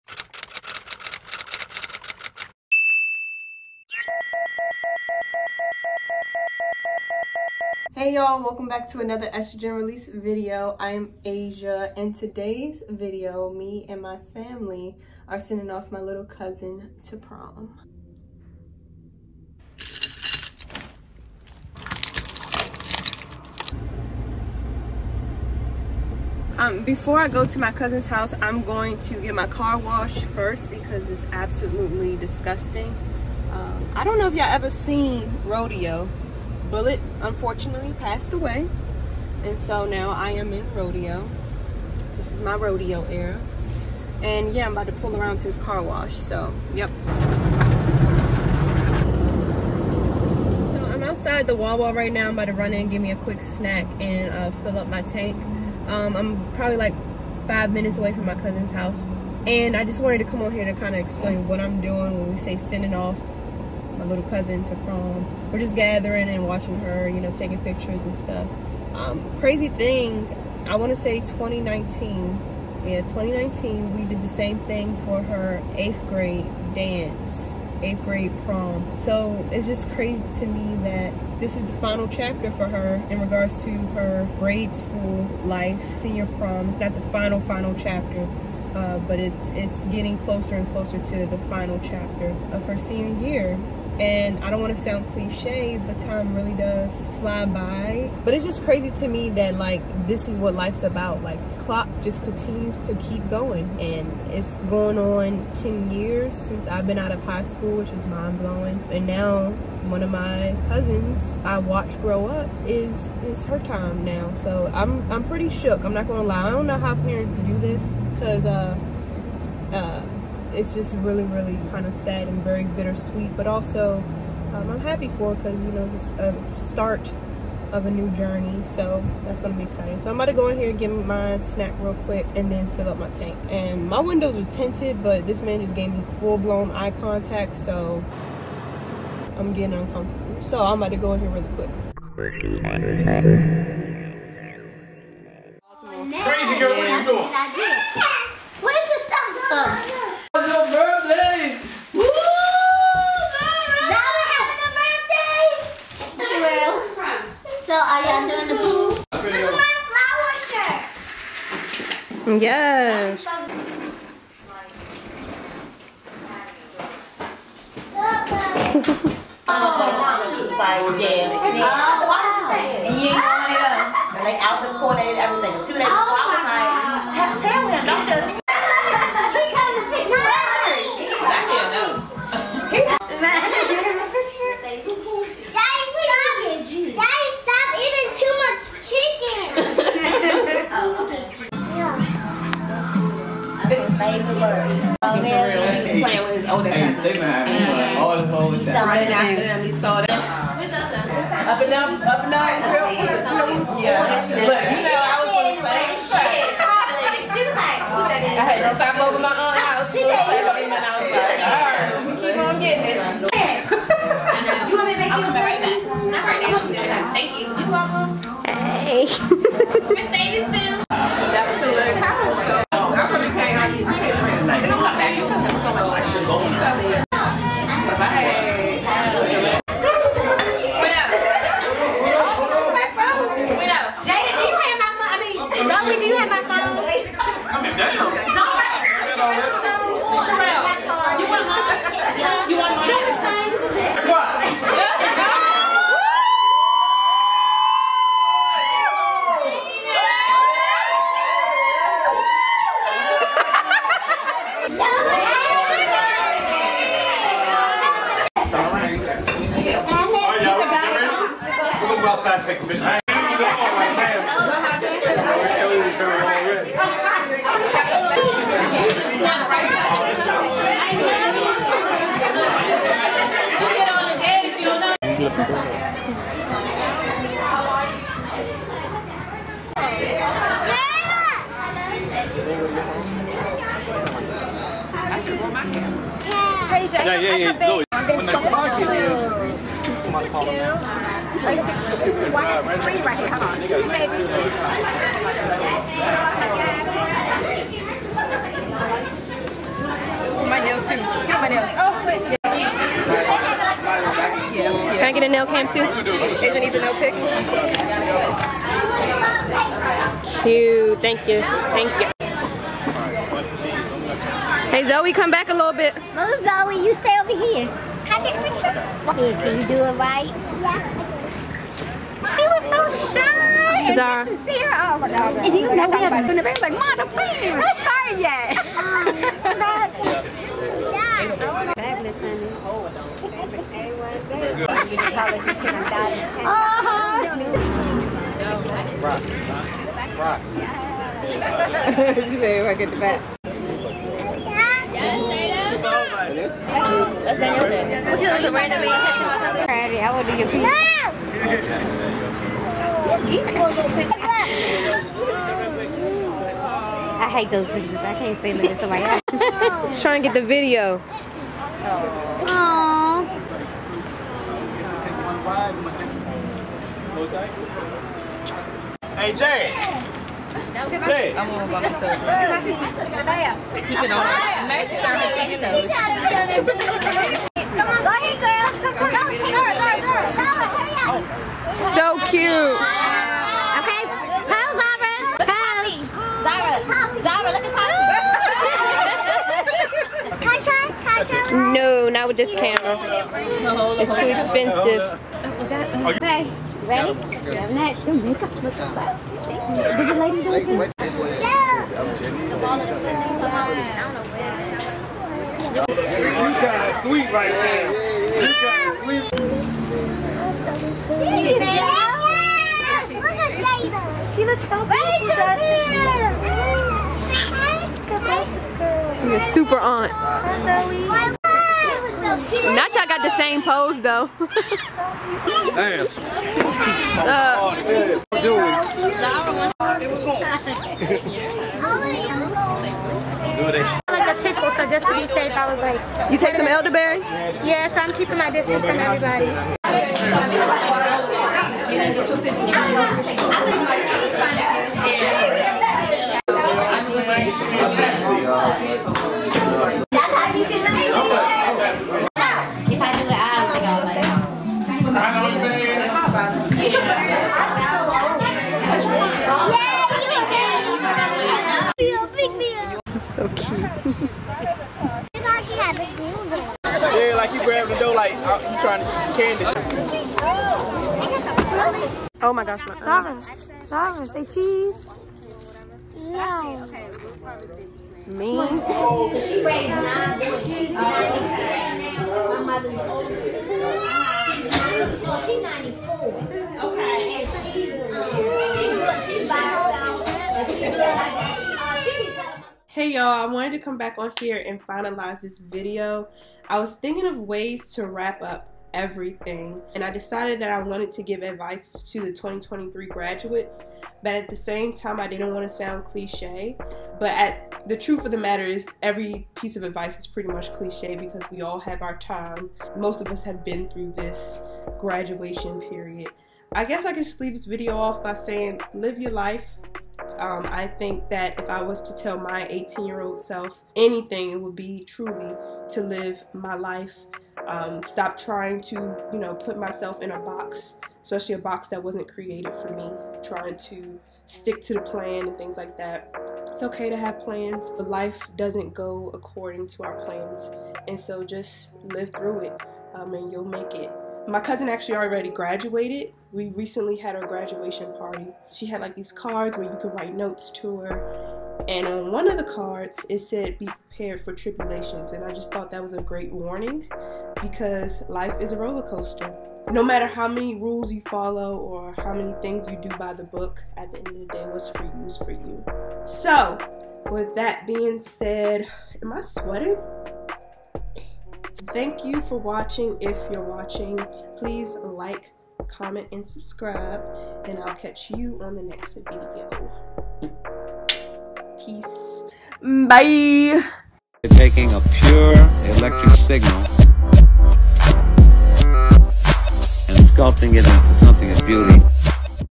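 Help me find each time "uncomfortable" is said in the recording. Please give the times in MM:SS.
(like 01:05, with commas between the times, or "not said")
02:19.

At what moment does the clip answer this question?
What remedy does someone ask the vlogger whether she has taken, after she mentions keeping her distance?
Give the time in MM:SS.
07:16.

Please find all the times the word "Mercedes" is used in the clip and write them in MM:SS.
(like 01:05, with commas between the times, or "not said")
03:39.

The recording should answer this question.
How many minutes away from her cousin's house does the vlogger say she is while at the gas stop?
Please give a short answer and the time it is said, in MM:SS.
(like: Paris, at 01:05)
5, at 00:57.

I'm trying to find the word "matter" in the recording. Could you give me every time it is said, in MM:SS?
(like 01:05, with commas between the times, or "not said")
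08:28, 09:20.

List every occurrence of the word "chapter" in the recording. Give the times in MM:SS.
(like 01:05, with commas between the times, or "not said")
01:22, 01:27, 01:31.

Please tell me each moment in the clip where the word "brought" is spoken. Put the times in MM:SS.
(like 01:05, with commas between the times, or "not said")
not said.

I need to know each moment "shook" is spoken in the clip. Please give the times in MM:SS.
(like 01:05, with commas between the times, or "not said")
01:55.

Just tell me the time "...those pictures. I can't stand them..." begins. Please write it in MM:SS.
05:57.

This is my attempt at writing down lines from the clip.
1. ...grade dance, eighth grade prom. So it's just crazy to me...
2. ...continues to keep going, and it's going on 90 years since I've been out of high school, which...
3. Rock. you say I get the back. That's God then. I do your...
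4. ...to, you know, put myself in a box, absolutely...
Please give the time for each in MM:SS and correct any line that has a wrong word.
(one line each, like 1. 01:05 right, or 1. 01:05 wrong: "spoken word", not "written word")
1. 01:16 right
2. 01:42 wrong: "10", not "90"
3. 05:40 wrong: "Daniel", not "God"
4. 08:48 wrong: "especially", not "absolutely".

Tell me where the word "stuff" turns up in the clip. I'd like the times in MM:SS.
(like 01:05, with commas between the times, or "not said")
01:08, 02:28.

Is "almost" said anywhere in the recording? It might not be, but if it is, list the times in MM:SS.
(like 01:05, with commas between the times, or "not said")
03:37.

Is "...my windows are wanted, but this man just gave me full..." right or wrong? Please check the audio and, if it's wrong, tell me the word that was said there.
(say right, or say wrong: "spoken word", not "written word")
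wrong: "tinted", not "wanted".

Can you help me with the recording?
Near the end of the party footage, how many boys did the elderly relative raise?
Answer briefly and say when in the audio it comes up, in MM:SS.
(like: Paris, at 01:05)
9, at 07:59.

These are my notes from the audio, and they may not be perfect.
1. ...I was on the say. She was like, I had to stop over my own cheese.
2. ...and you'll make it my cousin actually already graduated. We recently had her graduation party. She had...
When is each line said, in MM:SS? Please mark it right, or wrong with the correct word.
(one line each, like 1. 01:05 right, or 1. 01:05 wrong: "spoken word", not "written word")
1. 03:25 wrong: "house", not "cheese"
2. 09:03 right.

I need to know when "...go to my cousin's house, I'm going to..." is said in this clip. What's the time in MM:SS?
00:27.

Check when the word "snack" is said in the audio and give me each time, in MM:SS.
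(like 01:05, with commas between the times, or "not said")
00:53, 02:11.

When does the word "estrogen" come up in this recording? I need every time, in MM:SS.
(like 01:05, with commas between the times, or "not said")
00:09.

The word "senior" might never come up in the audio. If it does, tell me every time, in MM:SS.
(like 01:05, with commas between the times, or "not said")
01:26, 01:32.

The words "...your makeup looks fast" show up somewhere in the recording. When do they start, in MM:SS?
06:38.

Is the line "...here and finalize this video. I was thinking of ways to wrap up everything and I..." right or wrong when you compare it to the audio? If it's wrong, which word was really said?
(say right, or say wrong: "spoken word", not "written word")
right.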